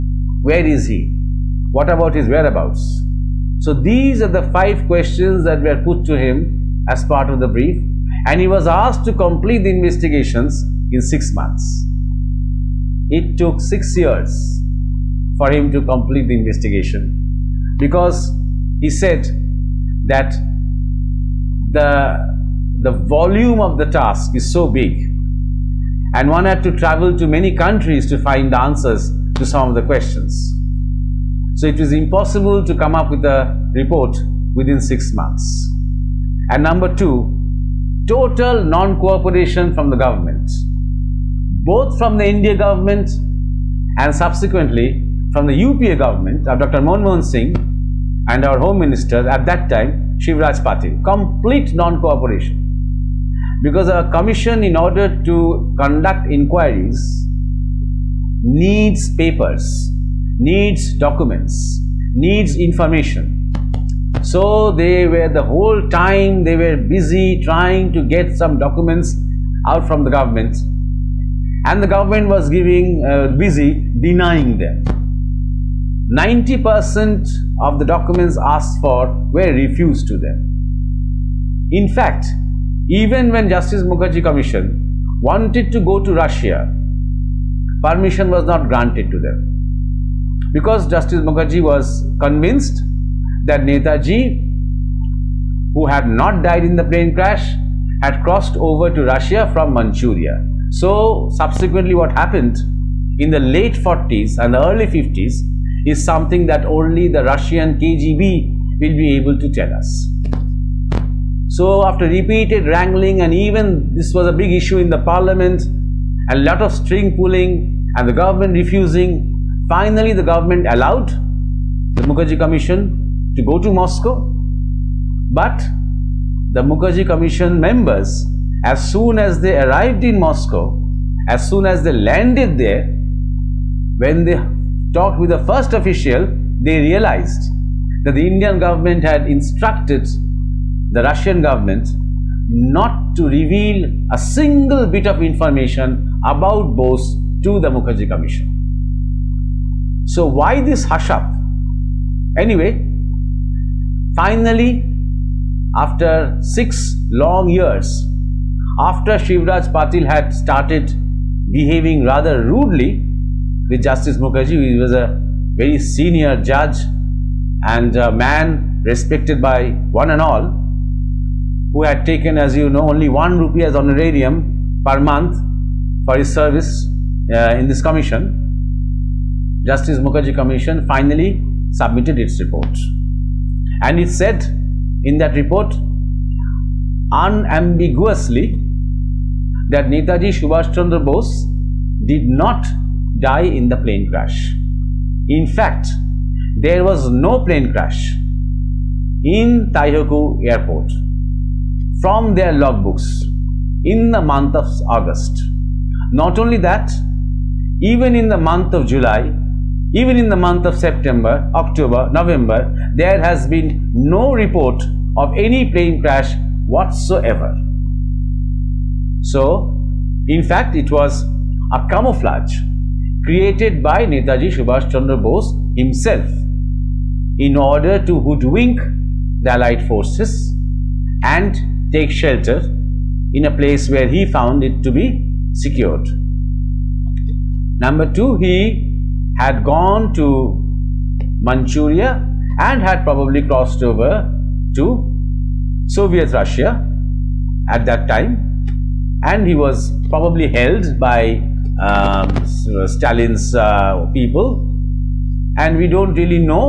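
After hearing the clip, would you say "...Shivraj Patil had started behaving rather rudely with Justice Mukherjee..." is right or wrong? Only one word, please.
right.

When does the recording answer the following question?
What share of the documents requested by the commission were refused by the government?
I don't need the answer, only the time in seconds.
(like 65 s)
76 s.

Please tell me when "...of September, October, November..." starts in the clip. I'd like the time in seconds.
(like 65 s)
210 s.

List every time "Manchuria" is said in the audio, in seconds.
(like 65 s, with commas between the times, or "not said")
99 s, 241 s.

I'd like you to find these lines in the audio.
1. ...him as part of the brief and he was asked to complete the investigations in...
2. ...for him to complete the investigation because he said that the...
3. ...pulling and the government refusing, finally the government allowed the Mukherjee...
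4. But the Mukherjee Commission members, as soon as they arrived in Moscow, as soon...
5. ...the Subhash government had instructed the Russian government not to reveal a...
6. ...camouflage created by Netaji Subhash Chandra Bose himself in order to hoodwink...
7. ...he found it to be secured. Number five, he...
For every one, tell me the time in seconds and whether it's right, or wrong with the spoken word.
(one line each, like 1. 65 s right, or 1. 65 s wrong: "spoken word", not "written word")
1. 6 s right
2. 15 s right
3. 117 s right
4. 125 s right
5. 138 s wrong: "Indian", not "Subhash"
6. 221 s right
7. 234 s wrong: "two", not "five".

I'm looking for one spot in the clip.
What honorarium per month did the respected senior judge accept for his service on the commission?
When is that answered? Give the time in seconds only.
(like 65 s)
173 s.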